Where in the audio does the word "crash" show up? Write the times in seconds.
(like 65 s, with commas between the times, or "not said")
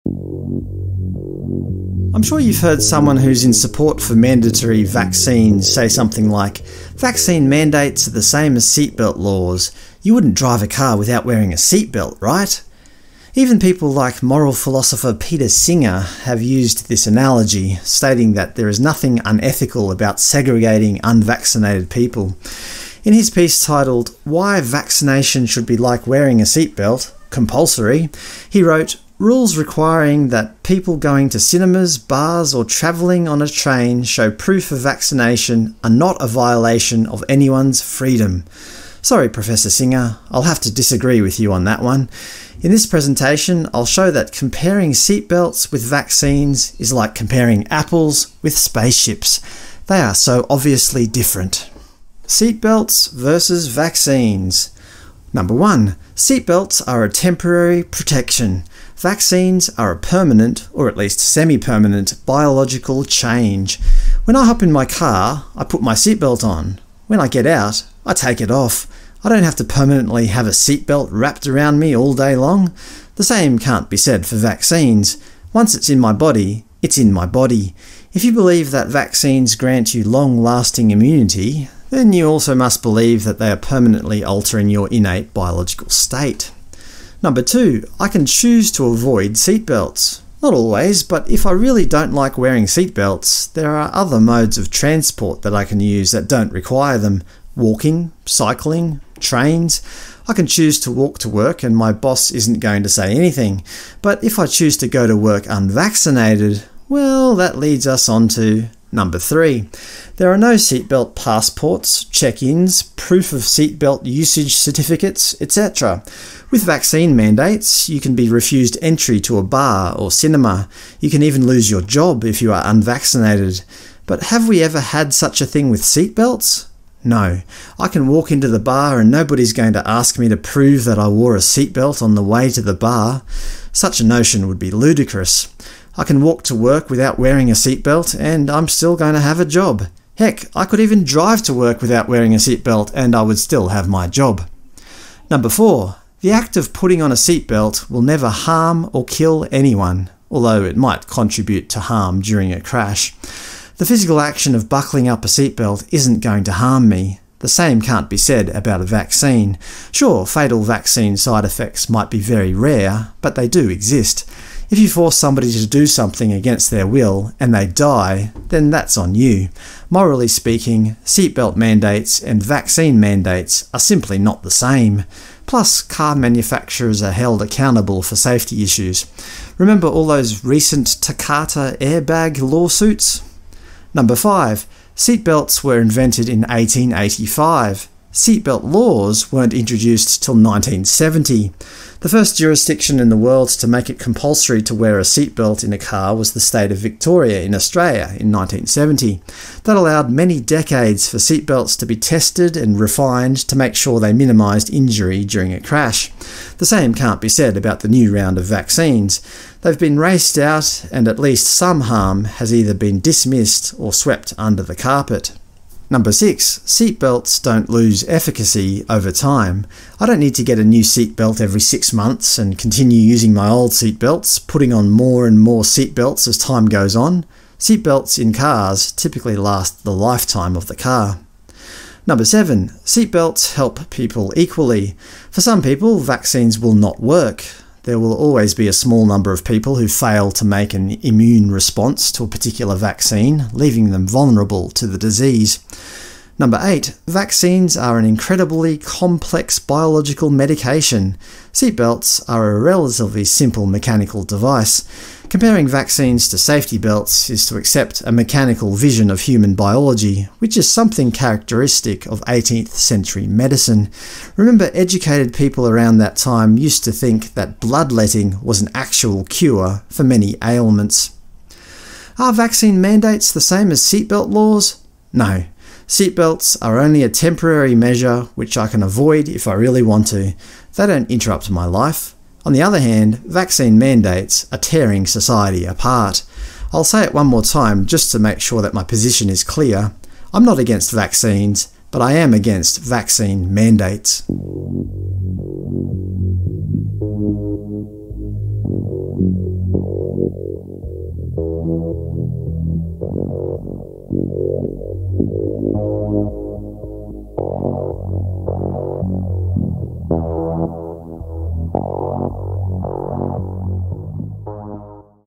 152 s, 205 s.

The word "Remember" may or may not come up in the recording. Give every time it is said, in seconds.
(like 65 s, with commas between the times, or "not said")
179 s, 264 s.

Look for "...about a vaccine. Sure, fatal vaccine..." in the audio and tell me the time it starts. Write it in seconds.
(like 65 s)
158 s.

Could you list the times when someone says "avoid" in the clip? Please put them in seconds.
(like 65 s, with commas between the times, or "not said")
88 s, 278 s.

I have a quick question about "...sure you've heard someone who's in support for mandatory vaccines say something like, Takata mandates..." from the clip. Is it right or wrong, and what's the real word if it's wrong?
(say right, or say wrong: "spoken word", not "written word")
wrong: "Vaccine", not "Takata".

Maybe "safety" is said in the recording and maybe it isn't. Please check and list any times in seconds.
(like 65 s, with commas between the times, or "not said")
178 s, 256 s.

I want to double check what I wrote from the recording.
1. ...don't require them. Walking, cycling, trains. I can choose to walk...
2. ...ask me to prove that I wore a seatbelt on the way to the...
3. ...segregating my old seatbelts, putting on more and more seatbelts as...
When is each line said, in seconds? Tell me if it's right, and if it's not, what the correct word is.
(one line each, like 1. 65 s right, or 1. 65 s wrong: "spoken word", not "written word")
1. 96 s right
2. 129 s right
3. 222 s wrong: "using", not "segregating".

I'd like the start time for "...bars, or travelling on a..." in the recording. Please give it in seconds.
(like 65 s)
31 s.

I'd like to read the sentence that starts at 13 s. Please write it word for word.
Even people like moral philosopher Peter Singer have used this analogy, stating that there is nothing unethical about segregating unvaccinated people.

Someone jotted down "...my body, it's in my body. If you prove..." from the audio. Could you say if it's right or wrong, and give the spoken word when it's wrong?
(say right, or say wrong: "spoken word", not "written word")
wrong: "believe", not "prove".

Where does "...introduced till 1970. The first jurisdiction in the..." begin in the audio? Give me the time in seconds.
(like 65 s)
189 s.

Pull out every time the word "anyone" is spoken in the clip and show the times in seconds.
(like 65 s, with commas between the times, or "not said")
37 s, 149 s.